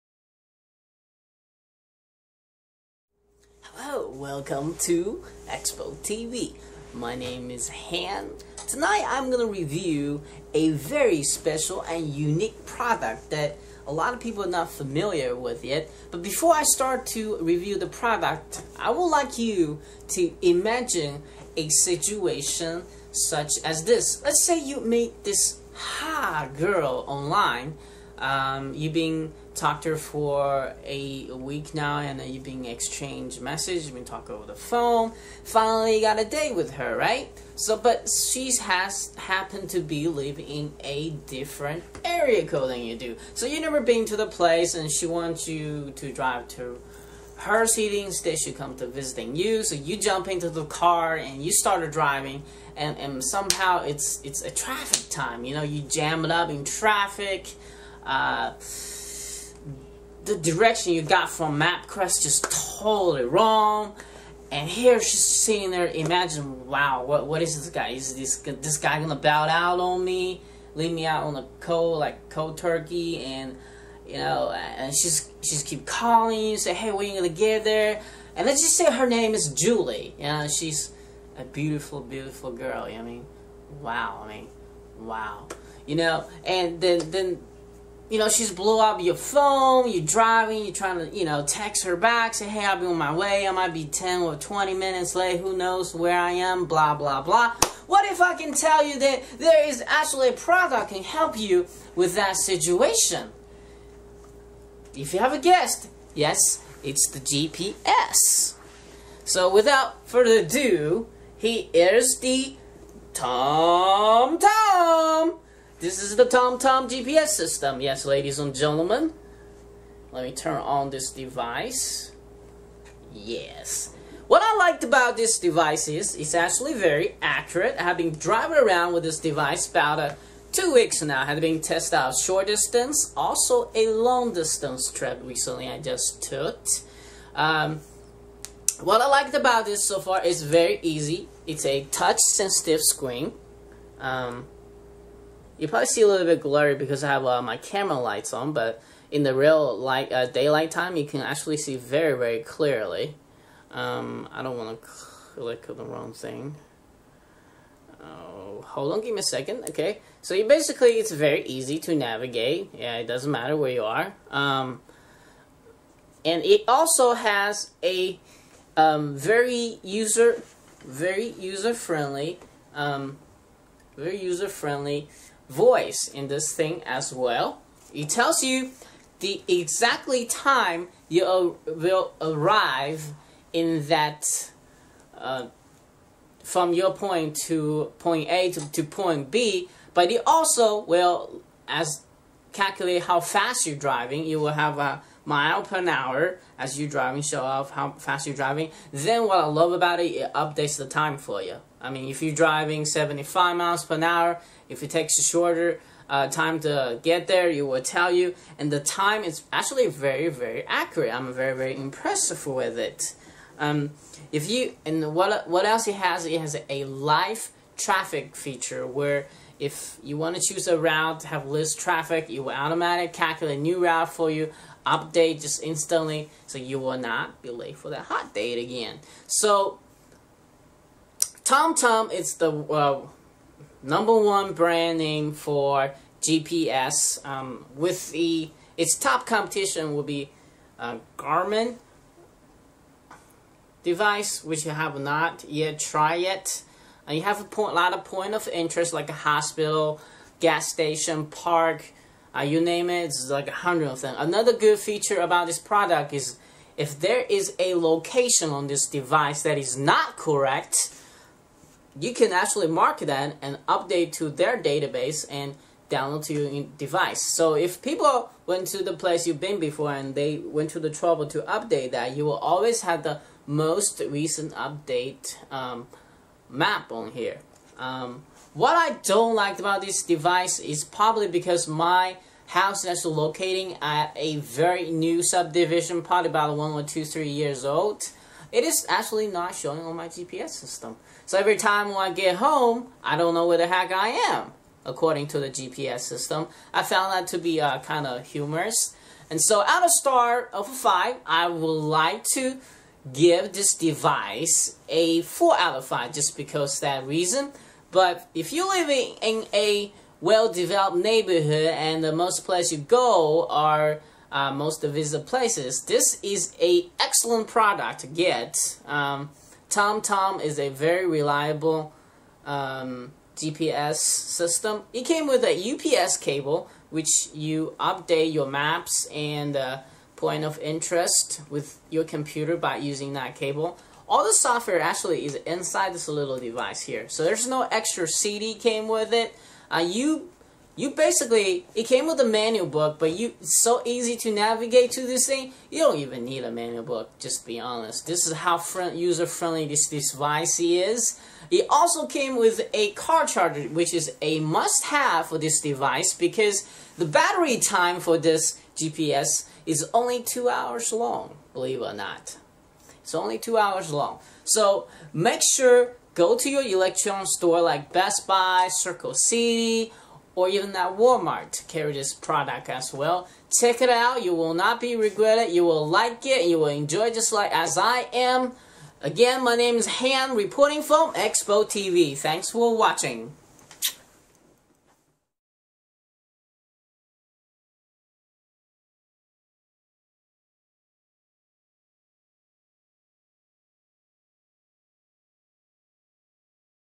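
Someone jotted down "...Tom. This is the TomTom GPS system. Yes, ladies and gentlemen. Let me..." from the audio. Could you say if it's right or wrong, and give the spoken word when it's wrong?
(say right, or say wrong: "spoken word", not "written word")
right.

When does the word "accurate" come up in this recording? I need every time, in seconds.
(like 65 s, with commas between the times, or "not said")
127 s, 210 s.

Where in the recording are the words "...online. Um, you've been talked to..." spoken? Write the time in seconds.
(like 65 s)
27 s.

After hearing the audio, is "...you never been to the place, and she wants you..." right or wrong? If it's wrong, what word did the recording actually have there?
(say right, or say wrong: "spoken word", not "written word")
right.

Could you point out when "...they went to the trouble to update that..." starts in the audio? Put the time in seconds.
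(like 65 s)
270 s.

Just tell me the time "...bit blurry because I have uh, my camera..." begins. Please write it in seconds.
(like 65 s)
146 s.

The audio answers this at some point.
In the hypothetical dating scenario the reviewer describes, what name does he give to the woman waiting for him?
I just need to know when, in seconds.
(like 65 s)
79 s.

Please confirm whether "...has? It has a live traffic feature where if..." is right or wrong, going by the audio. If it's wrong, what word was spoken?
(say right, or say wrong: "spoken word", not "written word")
right.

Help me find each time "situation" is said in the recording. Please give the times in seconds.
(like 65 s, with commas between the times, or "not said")
21 s, 102 s.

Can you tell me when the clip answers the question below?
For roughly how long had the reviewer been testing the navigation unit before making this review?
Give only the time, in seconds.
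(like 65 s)
130 s.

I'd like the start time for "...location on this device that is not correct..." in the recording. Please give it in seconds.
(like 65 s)
257 s.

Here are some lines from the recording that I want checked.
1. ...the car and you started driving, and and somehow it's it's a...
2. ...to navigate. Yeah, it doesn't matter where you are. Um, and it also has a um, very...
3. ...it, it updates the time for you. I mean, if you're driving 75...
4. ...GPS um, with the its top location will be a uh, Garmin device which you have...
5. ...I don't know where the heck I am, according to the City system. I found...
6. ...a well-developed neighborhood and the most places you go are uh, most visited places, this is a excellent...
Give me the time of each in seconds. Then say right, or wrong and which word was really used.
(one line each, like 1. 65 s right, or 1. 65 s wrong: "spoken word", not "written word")
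1. 50 s right
2. 161 s right
3. 199 s right
4. 236 s wrong: "competition", not "location"
5. 293 s wrong: "GPS", not "City"
6. 309 s right.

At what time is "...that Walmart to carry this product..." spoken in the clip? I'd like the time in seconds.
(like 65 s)
370 s.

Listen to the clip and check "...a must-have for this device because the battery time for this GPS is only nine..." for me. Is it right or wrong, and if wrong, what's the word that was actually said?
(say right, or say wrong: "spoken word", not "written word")
wrong: "two", not "nine".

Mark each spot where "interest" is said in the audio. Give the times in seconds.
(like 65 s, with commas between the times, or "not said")
248 s, 330 s.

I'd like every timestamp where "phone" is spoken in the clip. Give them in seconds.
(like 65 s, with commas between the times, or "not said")
34 s, 89 s.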